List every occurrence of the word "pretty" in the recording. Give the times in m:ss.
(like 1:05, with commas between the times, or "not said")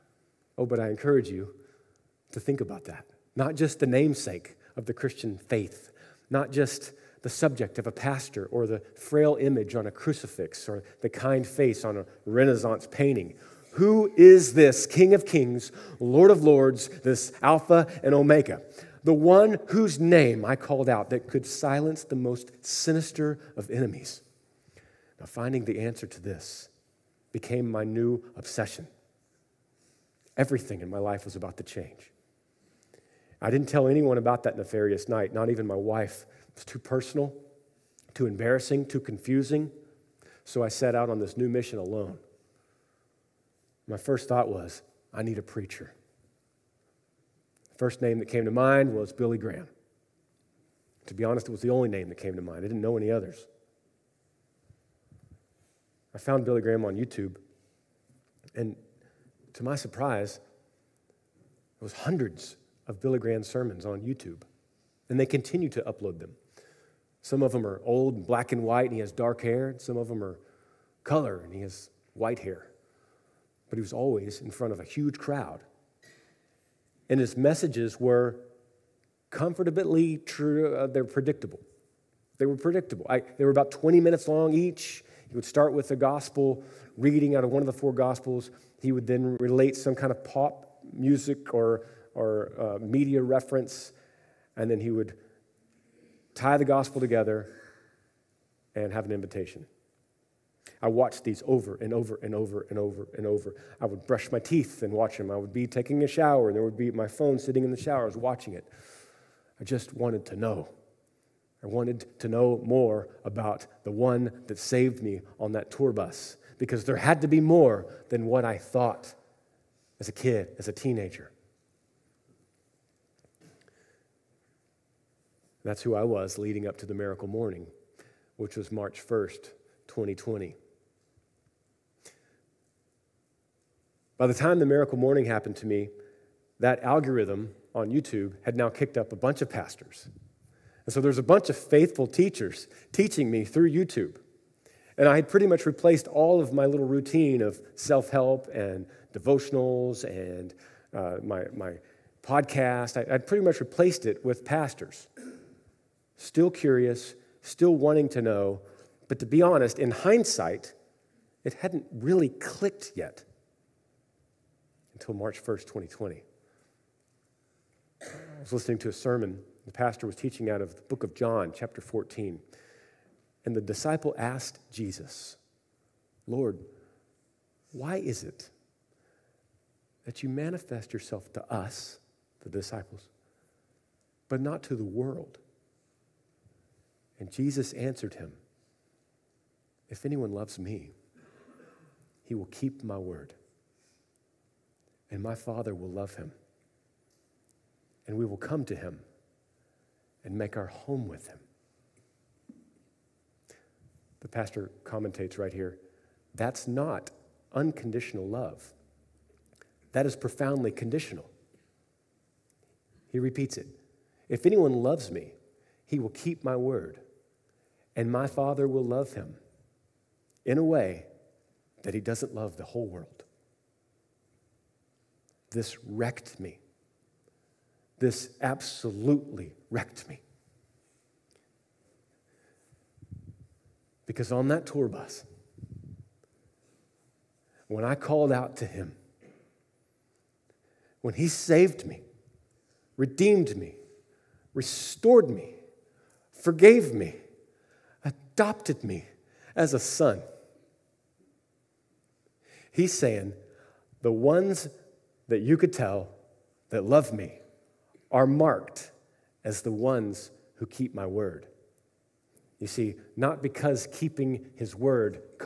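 2:25, 2:33.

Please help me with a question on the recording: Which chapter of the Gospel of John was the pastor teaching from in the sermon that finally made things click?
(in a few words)
14.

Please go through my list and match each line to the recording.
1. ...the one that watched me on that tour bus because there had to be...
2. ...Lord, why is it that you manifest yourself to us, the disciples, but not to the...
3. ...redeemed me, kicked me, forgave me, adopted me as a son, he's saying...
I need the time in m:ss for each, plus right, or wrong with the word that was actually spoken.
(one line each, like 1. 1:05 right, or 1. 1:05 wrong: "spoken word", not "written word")
1. 1:53 wrong: "saved", not "watched"
2. 2:56 right
3. 4:02 wrong: "restored", not "kicked".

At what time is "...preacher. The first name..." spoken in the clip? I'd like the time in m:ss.
0:45.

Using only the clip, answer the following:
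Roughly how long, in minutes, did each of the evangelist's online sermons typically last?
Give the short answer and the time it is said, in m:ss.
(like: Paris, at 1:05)
20, at 1:23.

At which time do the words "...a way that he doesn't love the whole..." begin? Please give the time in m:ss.
3:40.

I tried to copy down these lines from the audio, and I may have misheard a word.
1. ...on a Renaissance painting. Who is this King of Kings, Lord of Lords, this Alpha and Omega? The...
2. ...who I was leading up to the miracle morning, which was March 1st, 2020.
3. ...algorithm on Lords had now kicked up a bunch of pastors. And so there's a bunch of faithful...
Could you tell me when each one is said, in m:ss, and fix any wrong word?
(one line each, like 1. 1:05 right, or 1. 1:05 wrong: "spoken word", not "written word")
1. 0:11 right
2. 2:05 right
3. 2:16 wrong: "YouTube", not "Lords".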